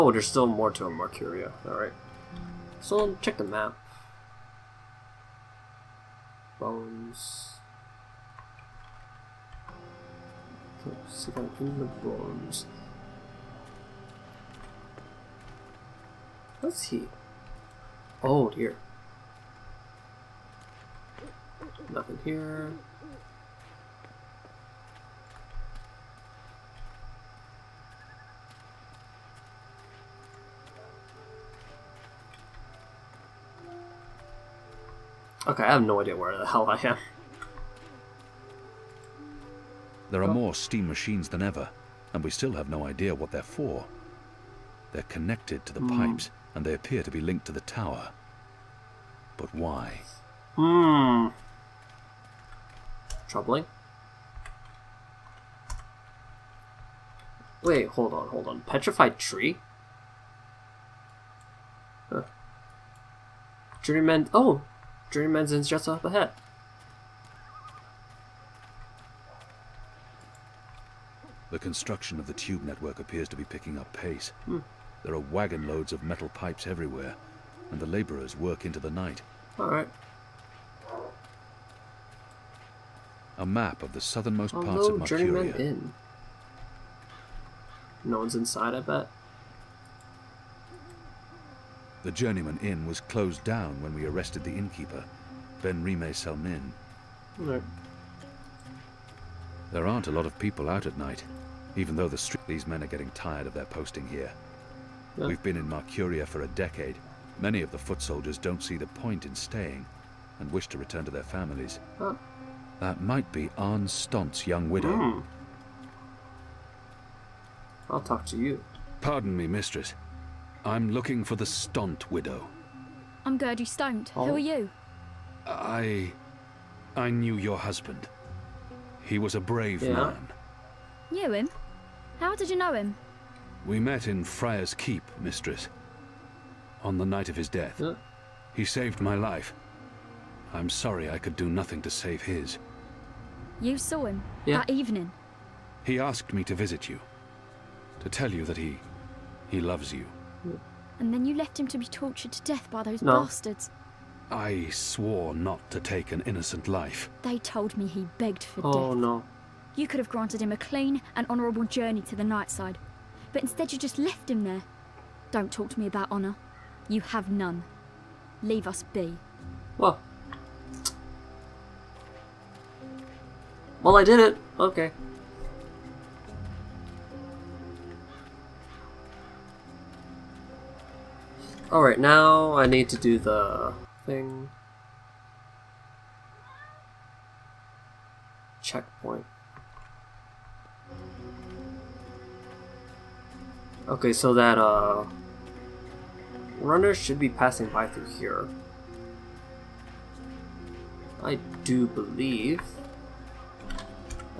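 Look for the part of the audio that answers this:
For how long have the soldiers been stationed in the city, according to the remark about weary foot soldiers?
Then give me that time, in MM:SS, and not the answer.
01:46.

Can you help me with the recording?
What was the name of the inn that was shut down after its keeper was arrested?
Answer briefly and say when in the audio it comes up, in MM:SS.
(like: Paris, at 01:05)
Journeyman Inn, at 01:32.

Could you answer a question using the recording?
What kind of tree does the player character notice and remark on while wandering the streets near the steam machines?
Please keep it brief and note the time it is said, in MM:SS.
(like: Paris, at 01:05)
Petrified tree, at 00:58.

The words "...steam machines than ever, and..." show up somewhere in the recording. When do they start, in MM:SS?
00:40.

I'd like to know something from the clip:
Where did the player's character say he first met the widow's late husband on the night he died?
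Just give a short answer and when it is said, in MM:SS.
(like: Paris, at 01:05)
Friar's Keep, at 02:14.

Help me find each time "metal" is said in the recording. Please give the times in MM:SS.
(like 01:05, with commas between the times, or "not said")
01:16.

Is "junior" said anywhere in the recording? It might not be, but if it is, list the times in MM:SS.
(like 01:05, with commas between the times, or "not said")
not said.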